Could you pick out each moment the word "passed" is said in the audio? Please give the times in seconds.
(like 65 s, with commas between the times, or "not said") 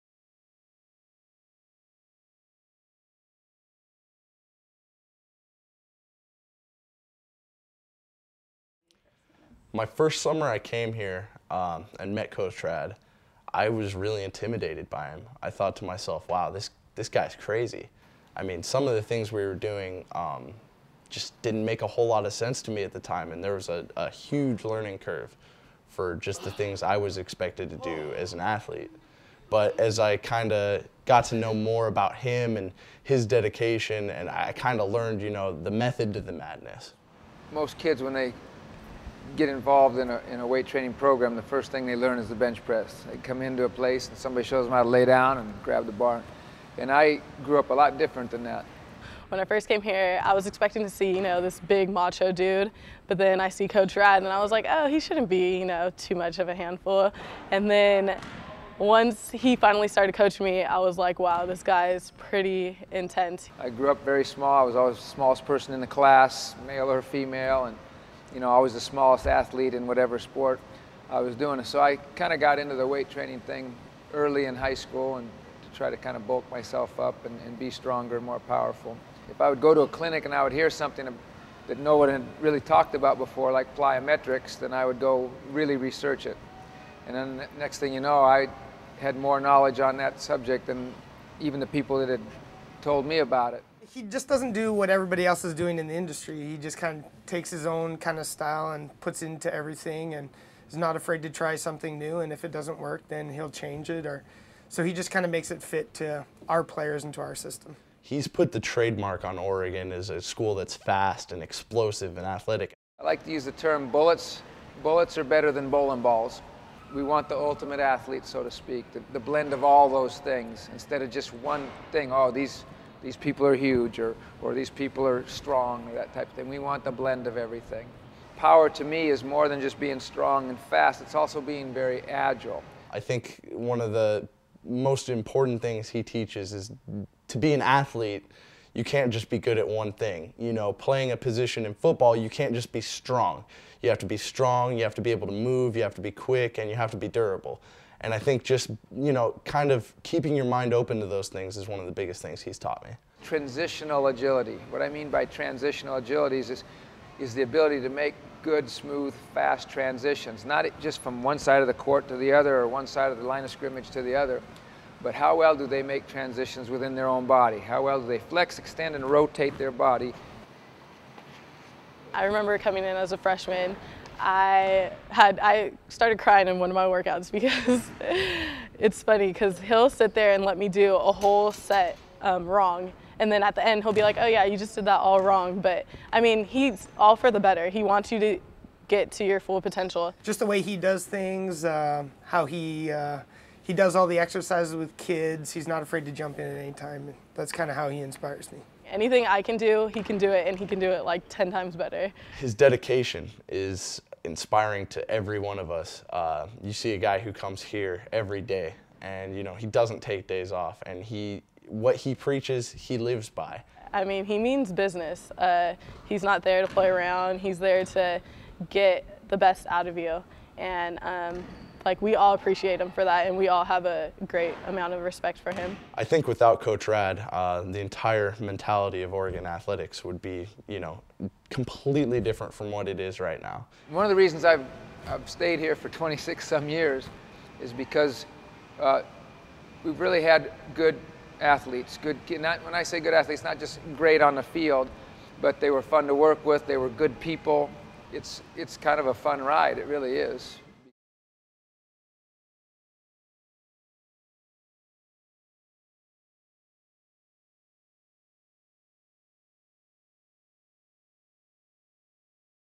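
not said.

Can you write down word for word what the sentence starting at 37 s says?
Most kids, when they get involved in a, in a weight training program, the first thing they learn is the bench press.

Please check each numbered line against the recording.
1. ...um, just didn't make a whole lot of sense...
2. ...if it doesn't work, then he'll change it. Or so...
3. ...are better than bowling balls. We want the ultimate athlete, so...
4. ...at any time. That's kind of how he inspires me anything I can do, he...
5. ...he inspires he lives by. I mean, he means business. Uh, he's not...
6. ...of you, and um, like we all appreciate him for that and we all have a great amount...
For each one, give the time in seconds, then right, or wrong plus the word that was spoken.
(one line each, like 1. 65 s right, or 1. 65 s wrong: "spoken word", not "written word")
1. 20 s right
2. 102 s right
3. 115 s right
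4. 196 s right
5. 211 s wrong: "preaches", not "inspires"
6. 219 s right.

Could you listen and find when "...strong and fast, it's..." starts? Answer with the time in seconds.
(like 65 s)
129 s.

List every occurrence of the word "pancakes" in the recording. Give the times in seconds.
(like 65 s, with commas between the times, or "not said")
not said.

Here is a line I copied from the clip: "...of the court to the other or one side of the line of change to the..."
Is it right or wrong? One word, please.
wrong.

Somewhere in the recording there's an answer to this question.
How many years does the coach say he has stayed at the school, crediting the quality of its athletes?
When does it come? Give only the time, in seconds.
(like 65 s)
235 s.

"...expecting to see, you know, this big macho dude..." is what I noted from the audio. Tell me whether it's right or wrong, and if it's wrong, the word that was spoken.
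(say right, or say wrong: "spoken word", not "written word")
right.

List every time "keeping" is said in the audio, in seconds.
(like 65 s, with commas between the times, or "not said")
150 s.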